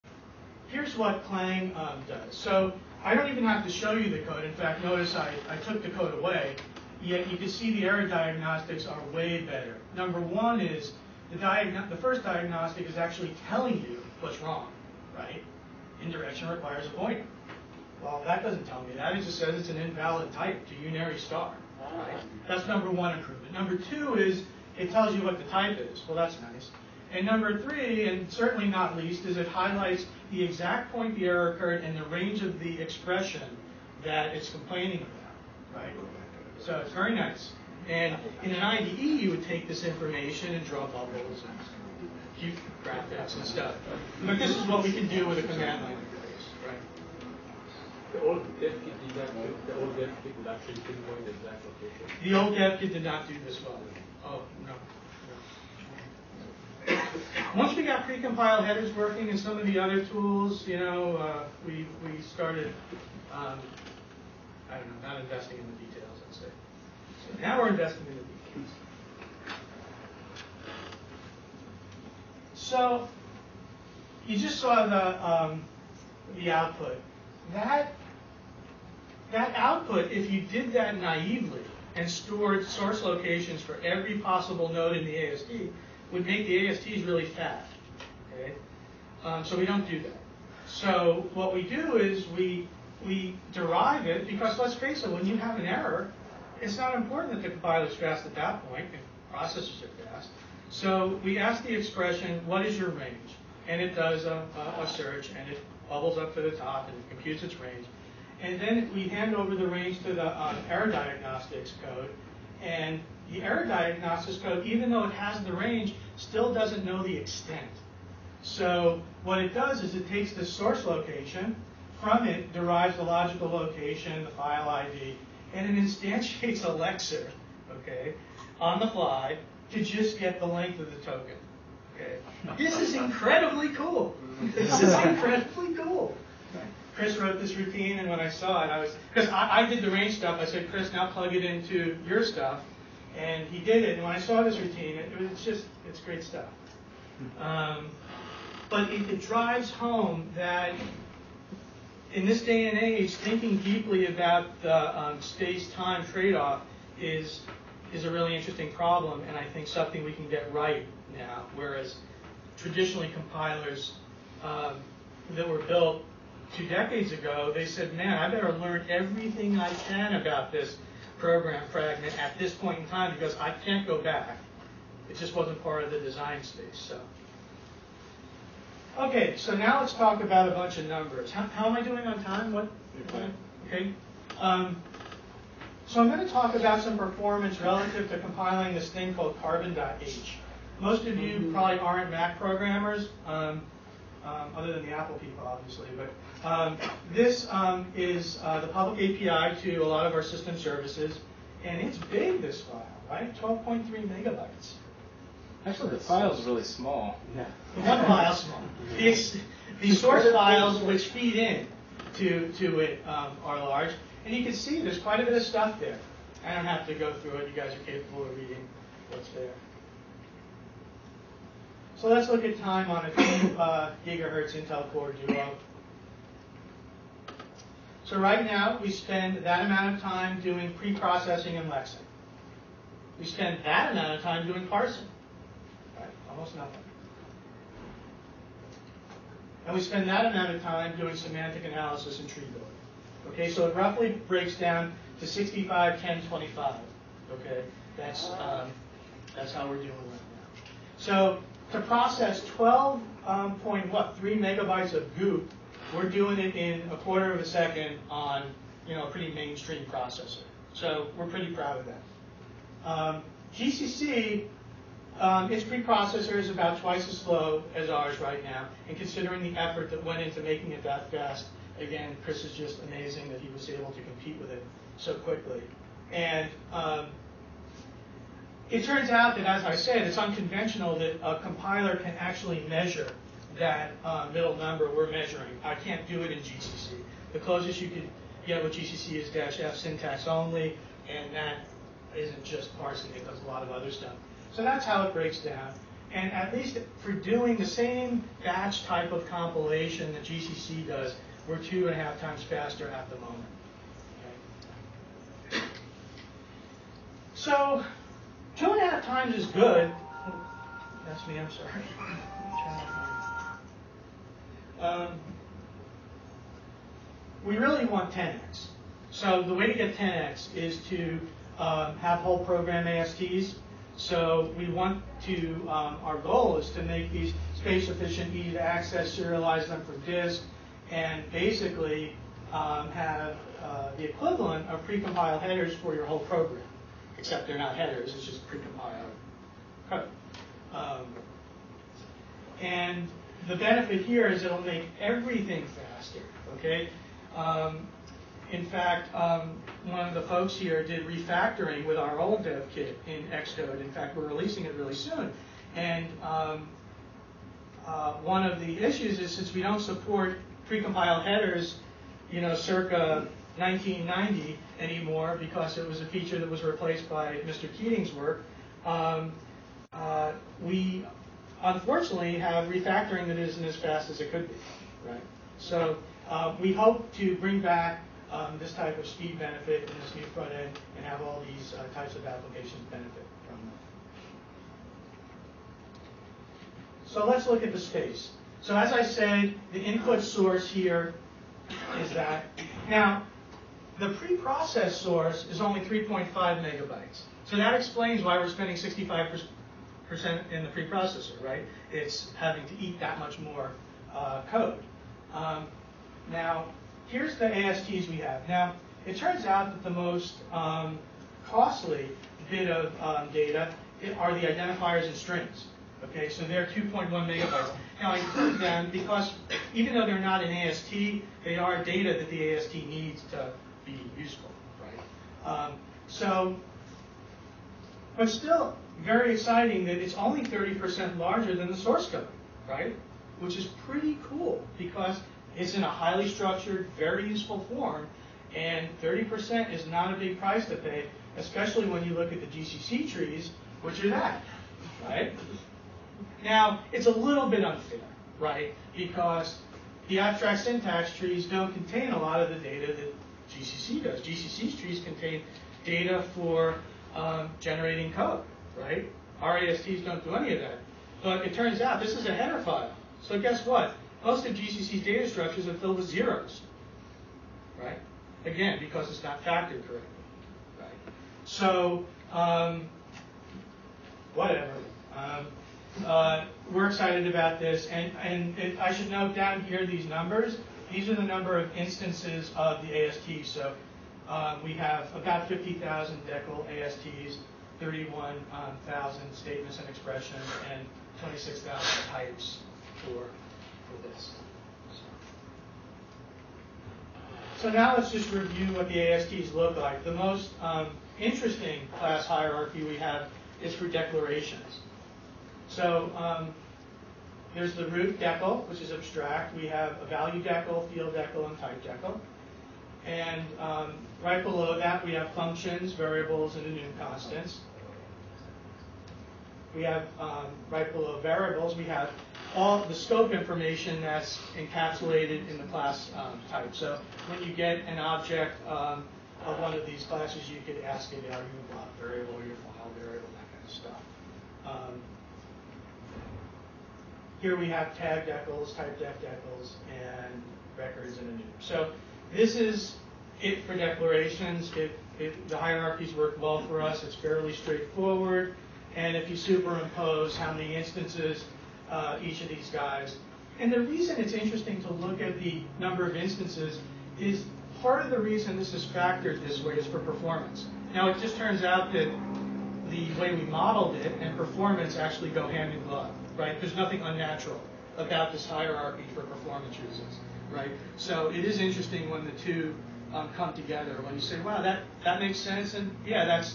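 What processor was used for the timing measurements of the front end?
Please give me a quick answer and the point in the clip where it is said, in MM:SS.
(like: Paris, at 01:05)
2 gigahertz Intel Core Duo, at 03:43.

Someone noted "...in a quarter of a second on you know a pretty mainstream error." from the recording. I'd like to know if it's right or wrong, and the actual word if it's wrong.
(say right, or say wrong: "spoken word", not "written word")
wrong: "processor", not "error".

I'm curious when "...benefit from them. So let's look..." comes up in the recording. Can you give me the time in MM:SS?
06:22.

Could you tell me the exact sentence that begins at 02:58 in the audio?
Okay, so now let's talk about a bunch of numbers.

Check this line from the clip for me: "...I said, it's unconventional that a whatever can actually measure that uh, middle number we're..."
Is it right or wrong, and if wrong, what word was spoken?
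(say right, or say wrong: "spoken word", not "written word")
wrong: "compiler", not "whatever".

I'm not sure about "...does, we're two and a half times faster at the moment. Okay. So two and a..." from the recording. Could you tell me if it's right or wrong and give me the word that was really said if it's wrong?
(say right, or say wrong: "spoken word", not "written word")
right.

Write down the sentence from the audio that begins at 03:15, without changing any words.
But um, this um, is uh, the public API to a lot of our system services, and it's big, this file, right?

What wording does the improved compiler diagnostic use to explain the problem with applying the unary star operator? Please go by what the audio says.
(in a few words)
Indirection requires a pointer.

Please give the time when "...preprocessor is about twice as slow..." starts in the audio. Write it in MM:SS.
04:25.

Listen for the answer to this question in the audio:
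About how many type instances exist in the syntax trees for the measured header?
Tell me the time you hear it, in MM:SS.
08:11.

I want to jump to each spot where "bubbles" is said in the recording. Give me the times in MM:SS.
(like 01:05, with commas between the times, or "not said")
00:40, 01:45.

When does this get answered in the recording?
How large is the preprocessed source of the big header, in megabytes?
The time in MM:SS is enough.
06:35.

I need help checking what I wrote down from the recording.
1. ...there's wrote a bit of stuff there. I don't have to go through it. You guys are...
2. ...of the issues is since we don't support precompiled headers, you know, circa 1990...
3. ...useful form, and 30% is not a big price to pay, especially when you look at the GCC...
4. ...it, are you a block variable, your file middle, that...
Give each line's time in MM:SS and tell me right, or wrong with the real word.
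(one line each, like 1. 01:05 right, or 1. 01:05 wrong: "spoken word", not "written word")
1. 03:34 wrong: "quite", not "wrote"
2. 05:58 right
3. 07:17 right
4. 08:51 wrong: "variable", not "middle".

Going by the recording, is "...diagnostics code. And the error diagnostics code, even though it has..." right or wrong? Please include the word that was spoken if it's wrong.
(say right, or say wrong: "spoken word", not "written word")
right.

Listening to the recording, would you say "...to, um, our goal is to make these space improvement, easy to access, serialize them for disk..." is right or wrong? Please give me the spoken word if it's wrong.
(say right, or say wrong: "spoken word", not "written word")
wrong: "efficient", not "improvement".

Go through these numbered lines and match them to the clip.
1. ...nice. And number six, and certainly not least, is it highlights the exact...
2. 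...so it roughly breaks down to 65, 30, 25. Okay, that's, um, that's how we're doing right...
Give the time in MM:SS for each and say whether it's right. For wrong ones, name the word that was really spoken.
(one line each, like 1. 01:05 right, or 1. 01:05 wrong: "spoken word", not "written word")
1. 00:26 wrong: "three", not "six"
2. 04:03 wrong: "10", not "30".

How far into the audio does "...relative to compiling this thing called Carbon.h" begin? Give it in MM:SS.
03:07.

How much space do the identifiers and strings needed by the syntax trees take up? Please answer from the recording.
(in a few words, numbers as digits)
2.1 megabytes.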